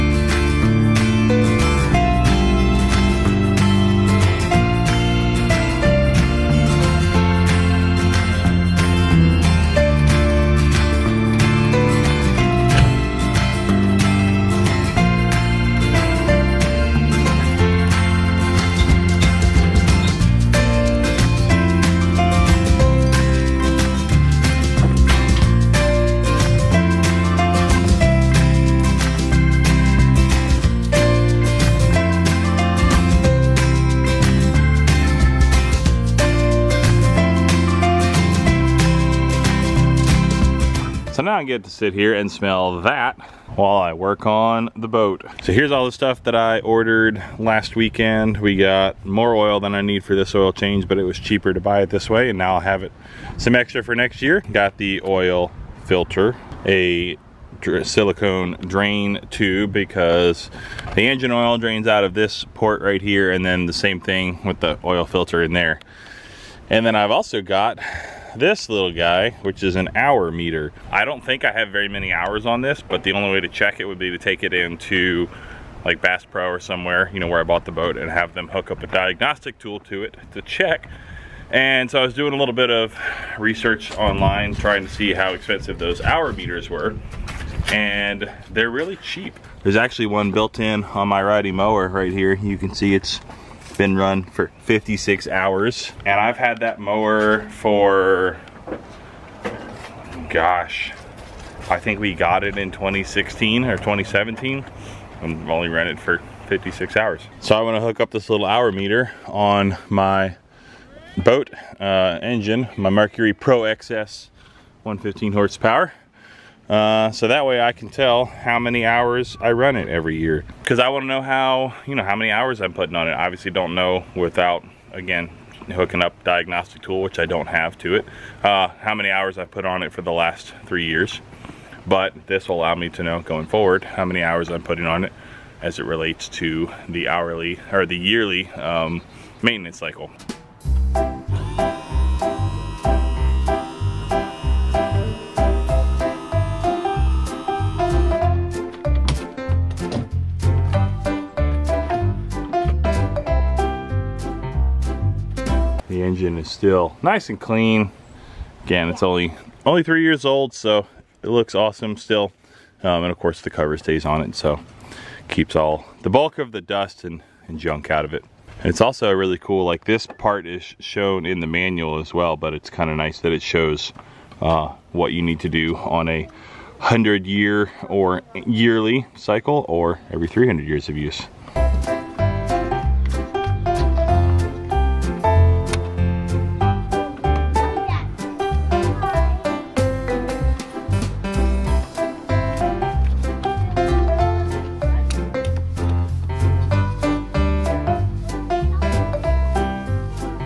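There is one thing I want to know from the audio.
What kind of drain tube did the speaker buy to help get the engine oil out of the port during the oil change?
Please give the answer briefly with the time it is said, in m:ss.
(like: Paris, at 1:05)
silicone, at 0:57.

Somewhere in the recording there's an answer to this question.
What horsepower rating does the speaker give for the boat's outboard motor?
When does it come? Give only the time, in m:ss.
1:54.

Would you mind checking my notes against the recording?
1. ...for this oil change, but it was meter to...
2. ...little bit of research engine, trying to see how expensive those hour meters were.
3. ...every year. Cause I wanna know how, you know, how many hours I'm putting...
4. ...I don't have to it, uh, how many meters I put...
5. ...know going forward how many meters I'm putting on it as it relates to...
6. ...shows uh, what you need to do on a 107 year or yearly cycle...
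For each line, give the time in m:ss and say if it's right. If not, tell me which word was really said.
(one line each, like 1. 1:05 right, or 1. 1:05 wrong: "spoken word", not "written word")
1. 0:50 wrong: "cheaper", not "meter"
2. 1:22 wrong: "online", not "engine"
3. 1:59 right
4. 2:07 wrong: "hours", not "meters"
5. 2:13 wrong: "hours", not "meters"
6. 2:53 wrong: "100", not "107".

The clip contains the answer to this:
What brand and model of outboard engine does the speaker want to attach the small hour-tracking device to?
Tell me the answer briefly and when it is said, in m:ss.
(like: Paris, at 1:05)
Mercury Pro XS, at 1:52.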